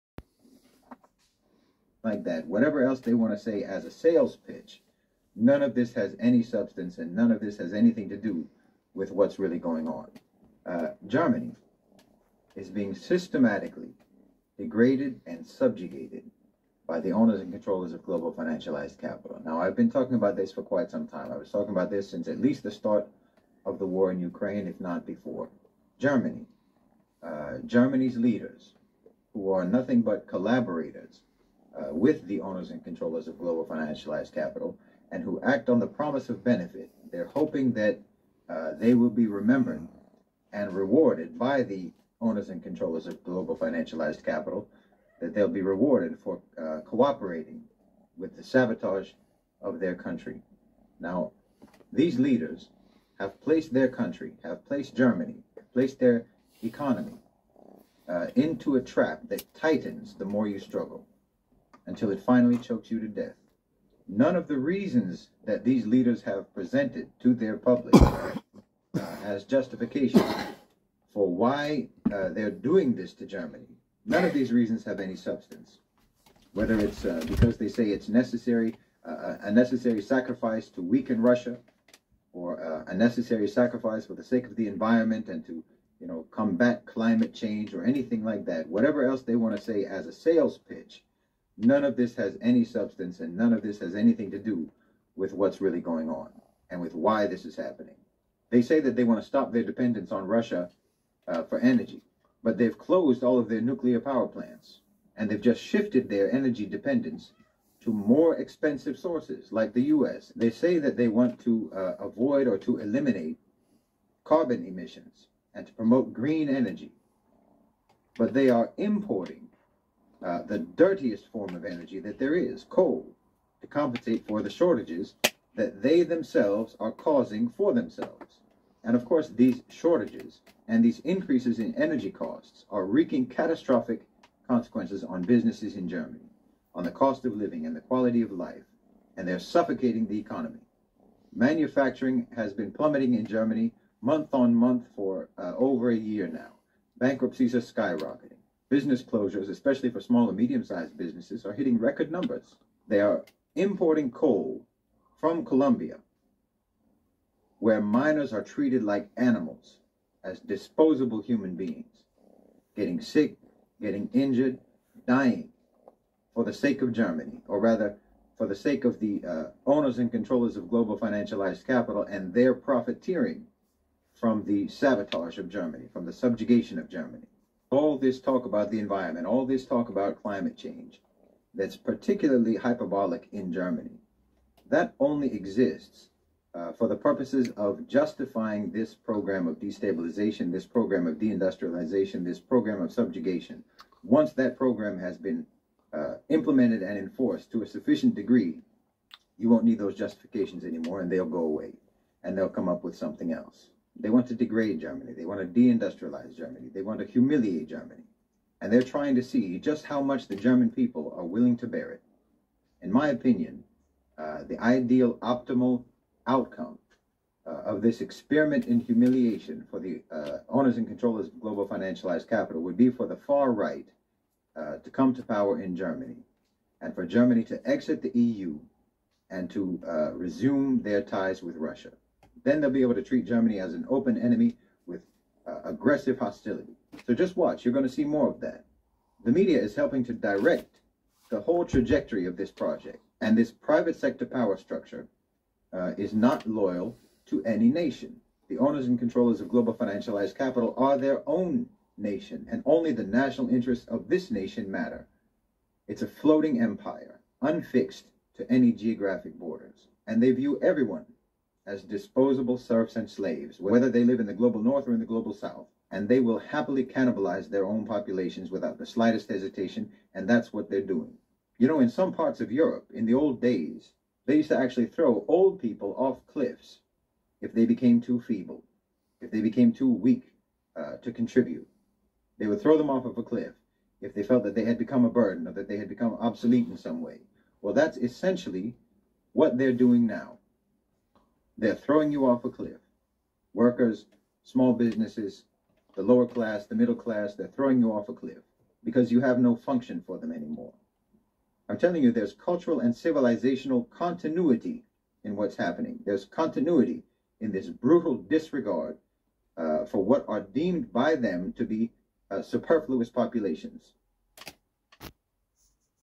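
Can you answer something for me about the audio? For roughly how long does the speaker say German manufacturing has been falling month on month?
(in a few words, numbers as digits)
over a year.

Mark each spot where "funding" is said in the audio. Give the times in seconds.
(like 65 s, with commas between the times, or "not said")
not said.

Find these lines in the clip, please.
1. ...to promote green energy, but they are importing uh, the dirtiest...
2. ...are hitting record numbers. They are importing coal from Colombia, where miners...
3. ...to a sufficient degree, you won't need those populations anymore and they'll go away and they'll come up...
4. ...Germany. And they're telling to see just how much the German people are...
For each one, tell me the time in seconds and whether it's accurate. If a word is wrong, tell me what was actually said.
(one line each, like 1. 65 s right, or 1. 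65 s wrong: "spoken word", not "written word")
1. 115 s right
2. 151 s right
3. 197 s wrong: "justifications", not "populations"
4. 207 s wrong: "trying", not "telling".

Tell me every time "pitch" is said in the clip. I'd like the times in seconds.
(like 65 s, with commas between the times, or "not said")
4 s, 90 s.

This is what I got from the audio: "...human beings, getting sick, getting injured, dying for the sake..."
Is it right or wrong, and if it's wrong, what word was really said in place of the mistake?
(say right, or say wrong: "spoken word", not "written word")
right.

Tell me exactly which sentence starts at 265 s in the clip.
And they will happily cannibalize their own populations without the slightest hesitation, and that's what they're doing.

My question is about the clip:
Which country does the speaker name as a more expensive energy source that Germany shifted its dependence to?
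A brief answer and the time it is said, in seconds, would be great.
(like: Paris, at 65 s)
US, at 109 s.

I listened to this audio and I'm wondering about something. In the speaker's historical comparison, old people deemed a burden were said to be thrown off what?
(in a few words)
cliffs.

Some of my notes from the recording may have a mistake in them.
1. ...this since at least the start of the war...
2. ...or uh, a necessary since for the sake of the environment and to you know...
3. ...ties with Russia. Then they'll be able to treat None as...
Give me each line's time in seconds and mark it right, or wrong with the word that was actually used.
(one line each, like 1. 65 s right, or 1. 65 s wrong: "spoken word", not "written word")
1. 21 s right
2. 82 s wrong: "sacrifice", not "since"
3. 231 s wrong: "Germany", not "None".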